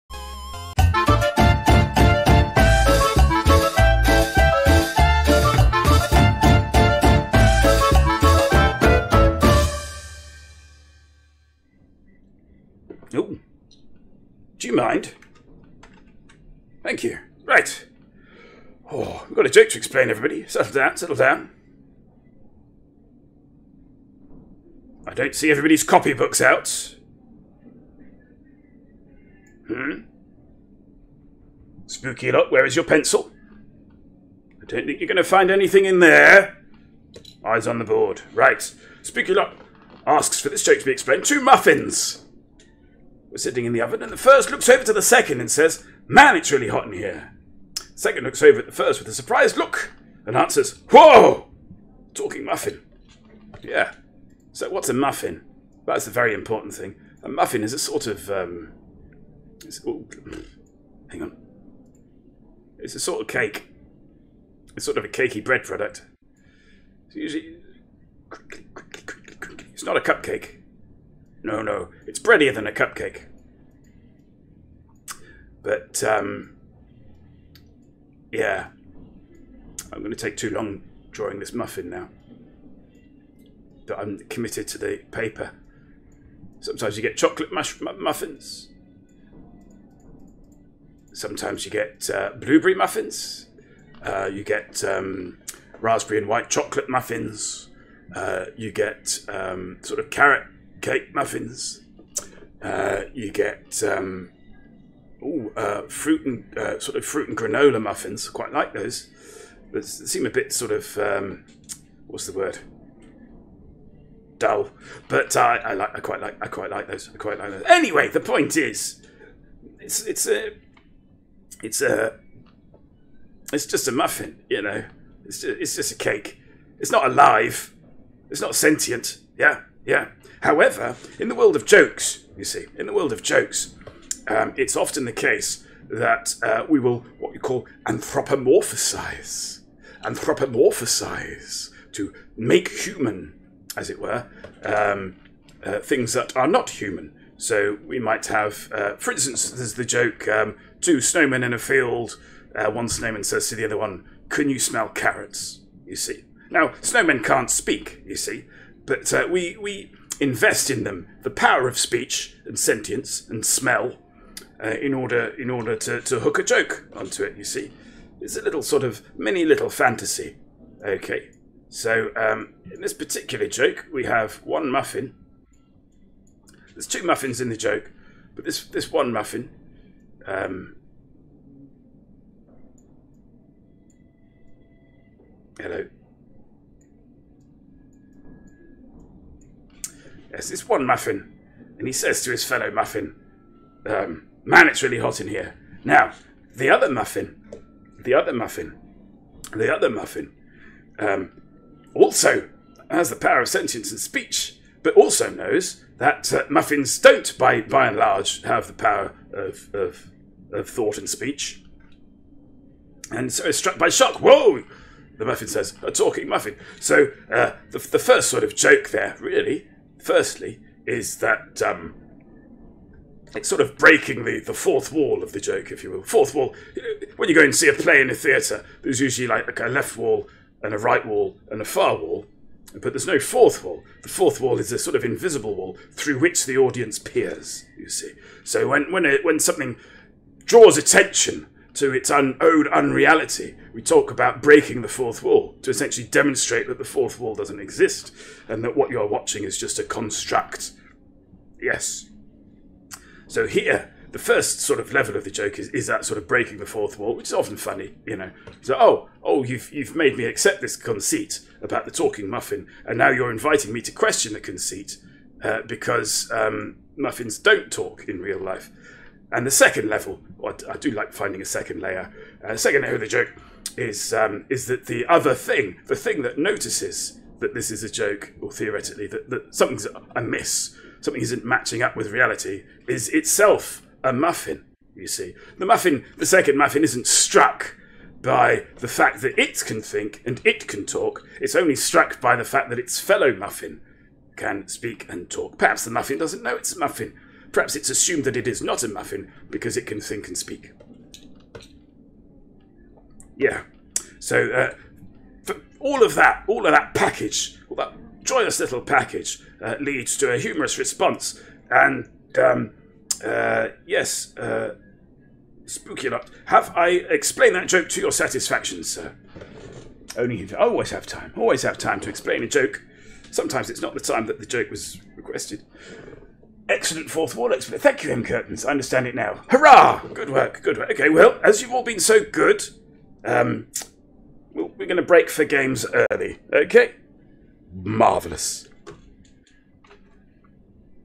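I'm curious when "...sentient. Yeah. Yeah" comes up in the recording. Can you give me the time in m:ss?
2:08.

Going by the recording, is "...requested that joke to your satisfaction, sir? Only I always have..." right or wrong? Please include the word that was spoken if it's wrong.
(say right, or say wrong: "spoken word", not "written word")
wrong: "explained", not "requested".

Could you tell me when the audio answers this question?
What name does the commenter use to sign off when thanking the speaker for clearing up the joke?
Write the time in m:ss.
5:28.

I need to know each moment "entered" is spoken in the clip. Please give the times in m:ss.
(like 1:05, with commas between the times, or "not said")
not said.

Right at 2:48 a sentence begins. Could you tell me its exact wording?
It's a little sort of mini little fantasy.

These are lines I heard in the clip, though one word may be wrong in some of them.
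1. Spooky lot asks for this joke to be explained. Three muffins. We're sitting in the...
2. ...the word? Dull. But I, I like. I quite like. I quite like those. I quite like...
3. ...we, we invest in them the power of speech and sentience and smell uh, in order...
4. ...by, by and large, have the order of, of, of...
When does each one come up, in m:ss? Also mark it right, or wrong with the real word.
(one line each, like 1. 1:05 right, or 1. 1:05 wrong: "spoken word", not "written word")
1. 0:39 wrong: "Two", not "Three"
2. 1:52 right
3. 2:39 right
4. 3:27 wrong: "power", not "order".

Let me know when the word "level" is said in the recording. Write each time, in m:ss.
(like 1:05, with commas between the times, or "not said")
4:14, 4:29.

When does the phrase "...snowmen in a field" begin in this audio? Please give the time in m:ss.
2:30.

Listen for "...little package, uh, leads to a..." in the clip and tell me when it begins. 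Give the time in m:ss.
5:08.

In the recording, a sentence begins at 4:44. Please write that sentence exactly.
You see, the muffin, the second muffin, isn't struck by the fact that it can think and it can talk.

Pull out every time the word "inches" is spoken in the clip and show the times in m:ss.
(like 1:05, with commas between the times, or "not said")
not said.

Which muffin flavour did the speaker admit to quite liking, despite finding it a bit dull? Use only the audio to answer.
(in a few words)
Fruit and granola.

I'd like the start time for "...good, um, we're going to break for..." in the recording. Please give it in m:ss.
5:32.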